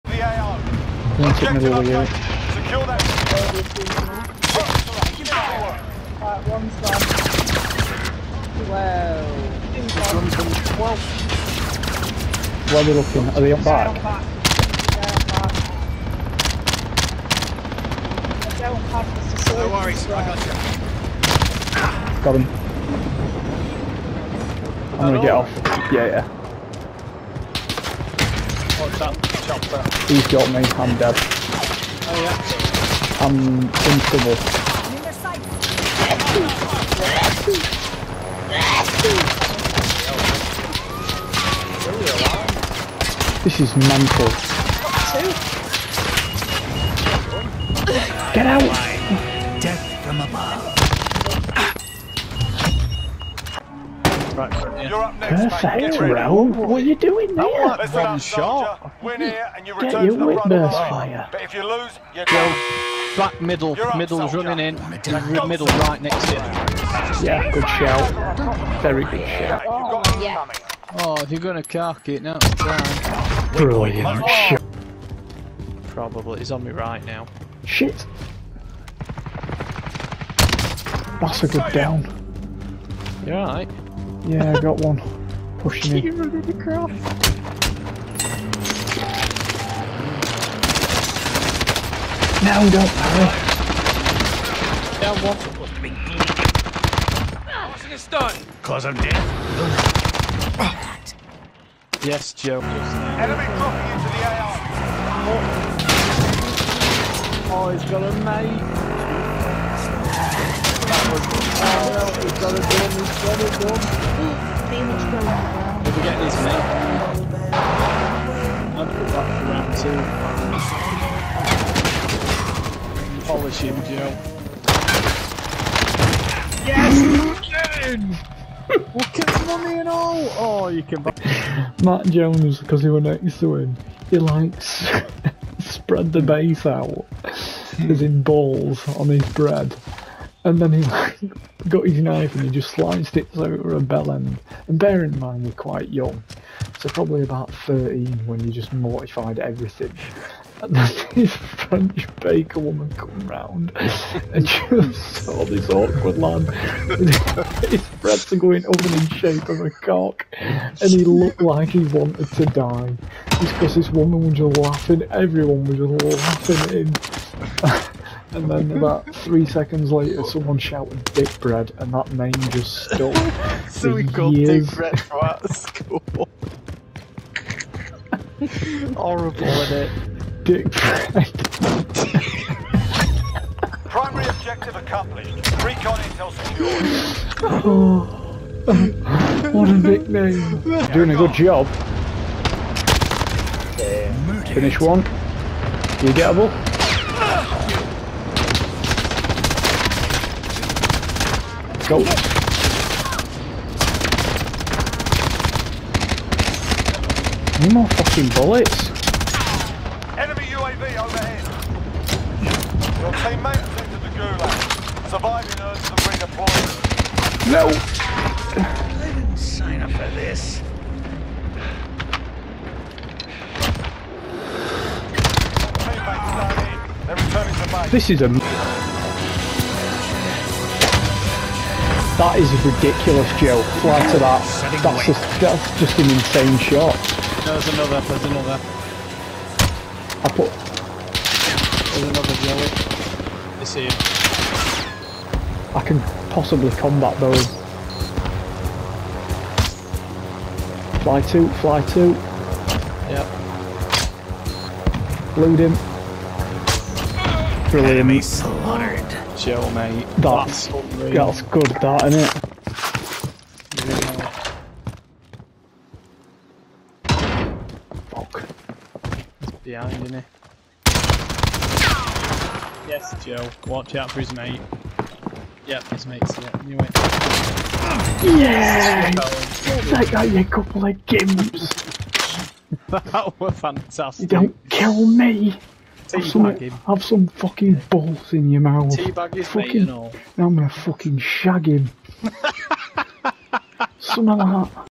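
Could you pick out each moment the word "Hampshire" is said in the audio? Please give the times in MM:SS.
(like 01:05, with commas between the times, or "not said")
not said.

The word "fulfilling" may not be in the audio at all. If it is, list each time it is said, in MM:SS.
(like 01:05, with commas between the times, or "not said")
not said.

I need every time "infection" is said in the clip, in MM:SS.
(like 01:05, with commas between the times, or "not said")
not said.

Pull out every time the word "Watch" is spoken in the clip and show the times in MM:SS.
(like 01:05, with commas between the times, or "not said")
04:33.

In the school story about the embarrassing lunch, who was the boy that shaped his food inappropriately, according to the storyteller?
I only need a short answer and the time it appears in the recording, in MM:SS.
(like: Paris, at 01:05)
Matt Jones, at 02:11.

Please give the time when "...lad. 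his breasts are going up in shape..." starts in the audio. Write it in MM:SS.
02:36.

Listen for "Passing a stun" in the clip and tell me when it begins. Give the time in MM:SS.
01:37.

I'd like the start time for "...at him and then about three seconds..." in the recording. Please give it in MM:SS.
02:46.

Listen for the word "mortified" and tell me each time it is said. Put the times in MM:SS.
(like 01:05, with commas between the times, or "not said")
02:28.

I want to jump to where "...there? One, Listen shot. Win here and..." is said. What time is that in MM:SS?
00:57.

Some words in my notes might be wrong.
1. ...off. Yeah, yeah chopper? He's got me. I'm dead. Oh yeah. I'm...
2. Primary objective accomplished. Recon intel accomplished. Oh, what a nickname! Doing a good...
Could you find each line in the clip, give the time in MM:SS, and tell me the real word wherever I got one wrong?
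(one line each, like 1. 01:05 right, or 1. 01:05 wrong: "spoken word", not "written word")
1. 00:25 right
2. 03:03 wrong: "secured", not "accomplished".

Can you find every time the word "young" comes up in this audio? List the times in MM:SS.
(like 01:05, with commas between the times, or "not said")
02:25.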